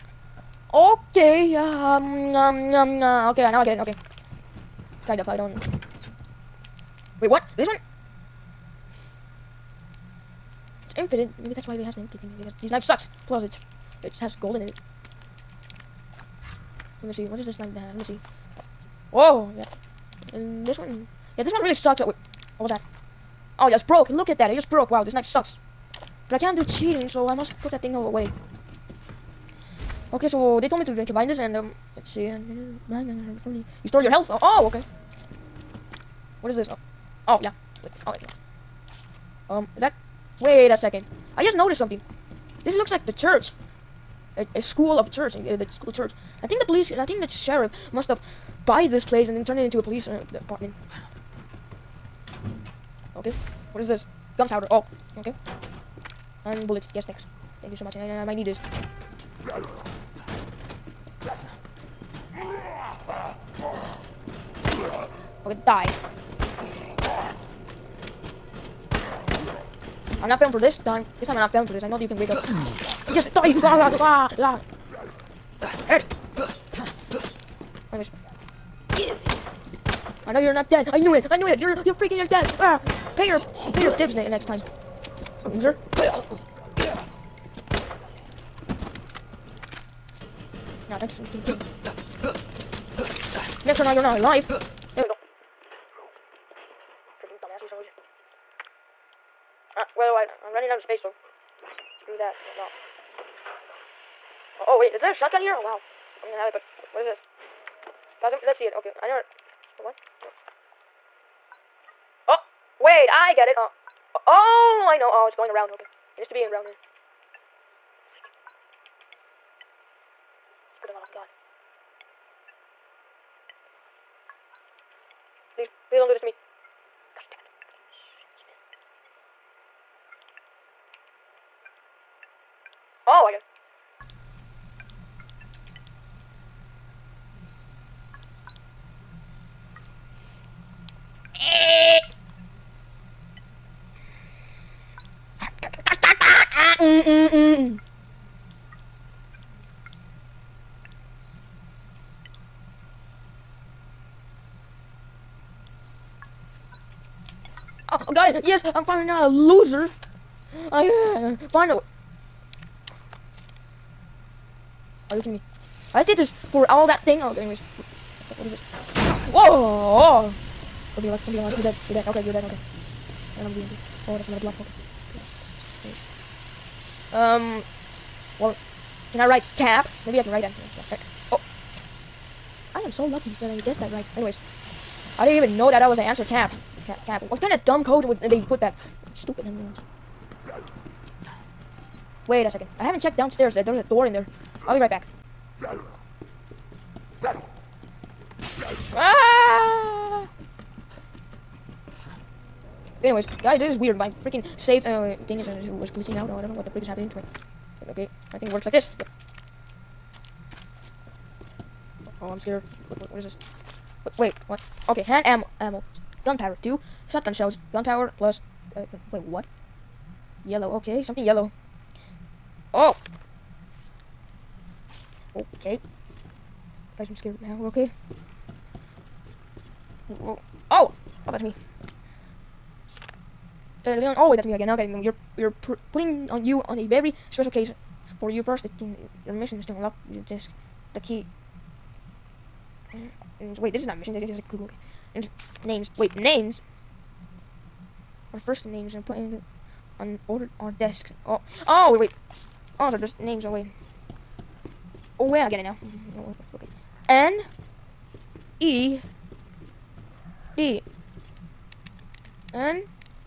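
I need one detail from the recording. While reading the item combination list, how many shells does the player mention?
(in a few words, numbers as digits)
2.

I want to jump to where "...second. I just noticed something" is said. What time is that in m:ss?
0:40.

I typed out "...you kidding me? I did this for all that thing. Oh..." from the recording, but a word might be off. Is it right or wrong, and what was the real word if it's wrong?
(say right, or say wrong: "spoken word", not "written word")
right.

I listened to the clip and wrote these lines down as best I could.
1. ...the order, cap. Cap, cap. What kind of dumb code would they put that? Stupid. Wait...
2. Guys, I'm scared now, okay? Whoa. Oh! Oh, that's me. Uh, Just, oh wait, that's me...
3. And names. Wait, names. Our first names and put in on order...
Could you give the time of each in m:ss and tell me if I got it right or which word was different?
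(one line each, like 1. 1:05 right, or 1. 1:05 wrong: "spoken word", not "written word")
1. 3:05 wrong: "answer", not "order"
2. 3:46 wrong: "Leon", not "Just"
3. 4:05 right.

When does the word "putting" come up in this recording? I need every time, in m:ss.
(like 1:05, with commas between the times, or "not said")
3:55.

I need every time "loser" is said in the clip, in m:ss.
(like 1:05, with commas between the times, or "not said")
1:25, 2:39.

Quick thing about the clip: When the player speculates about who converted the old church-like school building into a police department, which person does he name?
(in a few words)
the sheriff.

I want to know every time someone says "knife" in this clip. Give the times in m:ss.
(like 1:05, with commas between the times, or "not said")
0:25.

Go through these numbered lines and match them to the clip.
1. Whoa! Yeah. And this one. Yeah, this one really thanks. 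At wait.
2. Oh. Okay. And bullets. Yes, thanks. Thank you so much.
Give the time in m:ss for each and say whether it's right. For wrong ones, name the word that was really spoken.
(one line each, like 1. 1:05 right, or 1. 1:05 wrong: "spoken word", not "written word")
1. 0:19 wrong: "sucks", not "thanks"
2. 0:54 right.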